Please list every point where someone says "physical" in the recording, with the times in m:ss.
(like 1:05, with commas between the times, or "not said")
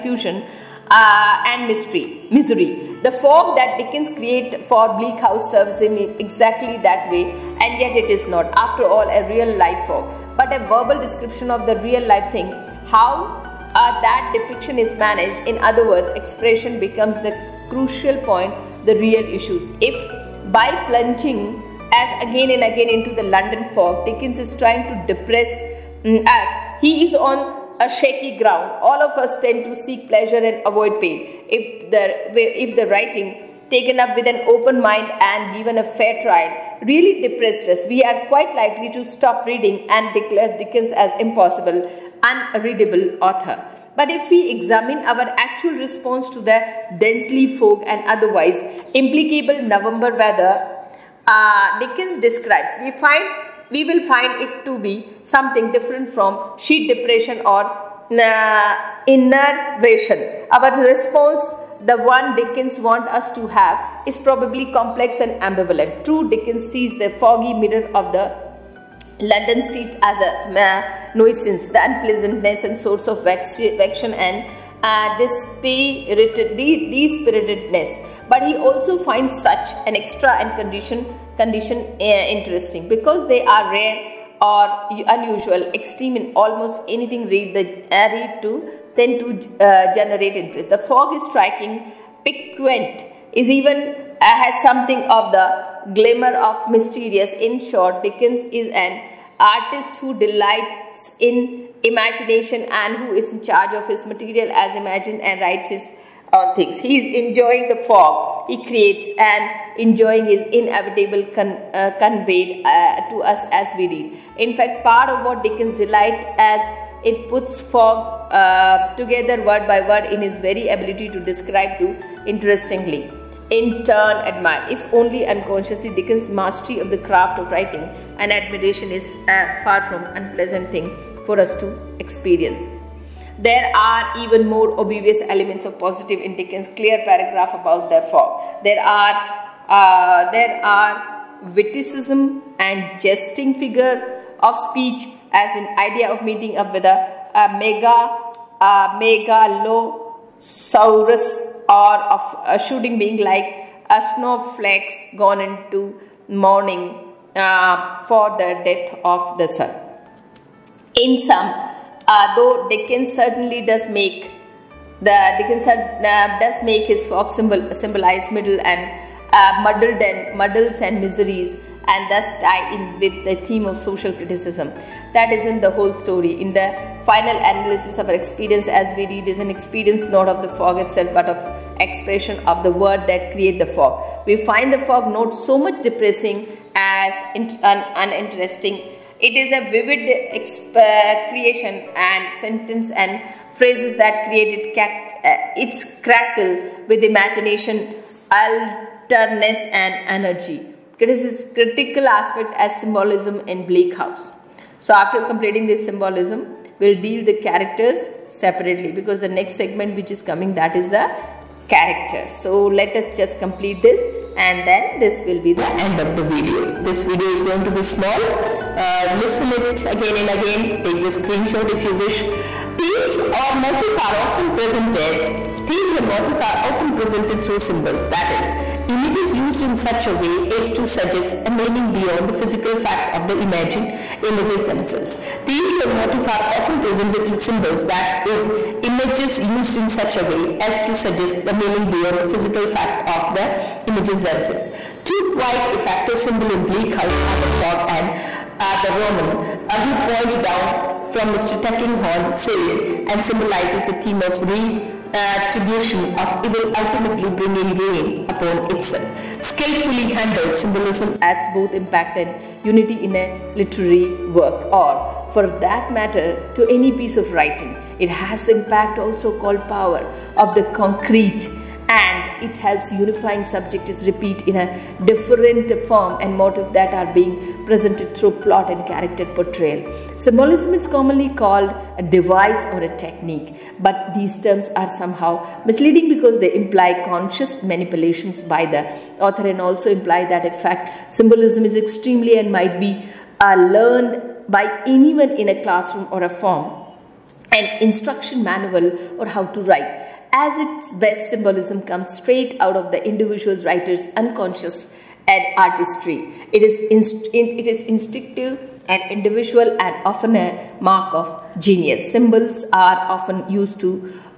3:52, 4:02.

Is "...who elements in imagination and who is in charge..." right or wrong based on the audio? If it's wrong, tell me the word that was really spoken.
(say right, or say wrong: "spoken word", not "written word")
wrong: "delights", not "elements".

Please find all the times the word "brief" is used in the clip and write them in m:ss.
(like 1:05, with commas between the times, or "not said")
not said.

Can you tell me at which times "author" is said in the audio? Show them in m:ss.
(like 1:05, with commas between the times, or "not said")
0:43, 4:49.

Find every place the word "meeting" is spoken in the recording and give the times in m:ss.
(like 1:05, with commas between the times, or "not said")
2:26.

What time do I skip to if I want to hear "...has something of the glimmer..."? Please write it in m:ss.
1:34.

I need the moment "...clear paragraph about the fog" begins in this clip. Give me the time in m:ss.
2:16.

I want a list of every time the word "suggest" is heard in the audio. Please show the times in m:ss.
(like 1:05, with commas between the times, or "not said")
3:50, 4:00.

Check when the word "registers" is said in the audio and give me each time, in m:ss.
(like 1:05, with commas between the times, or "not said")
not said.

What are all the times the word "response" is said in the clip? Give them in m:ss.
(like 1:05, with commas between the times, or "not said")
0:45, 1:00.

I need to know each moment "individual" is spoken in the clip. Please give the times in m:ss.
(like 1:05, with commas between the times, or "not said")
5:03, 5:09.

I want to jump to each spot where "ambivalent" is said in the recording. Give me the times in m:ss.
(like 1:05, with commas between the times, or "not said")
1:05.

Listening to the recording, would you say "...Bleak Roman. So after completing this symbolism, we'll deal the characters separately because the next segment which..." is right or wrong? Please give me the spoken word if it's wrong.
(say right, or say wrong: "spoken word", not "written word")
wrong: "House", not "Roman".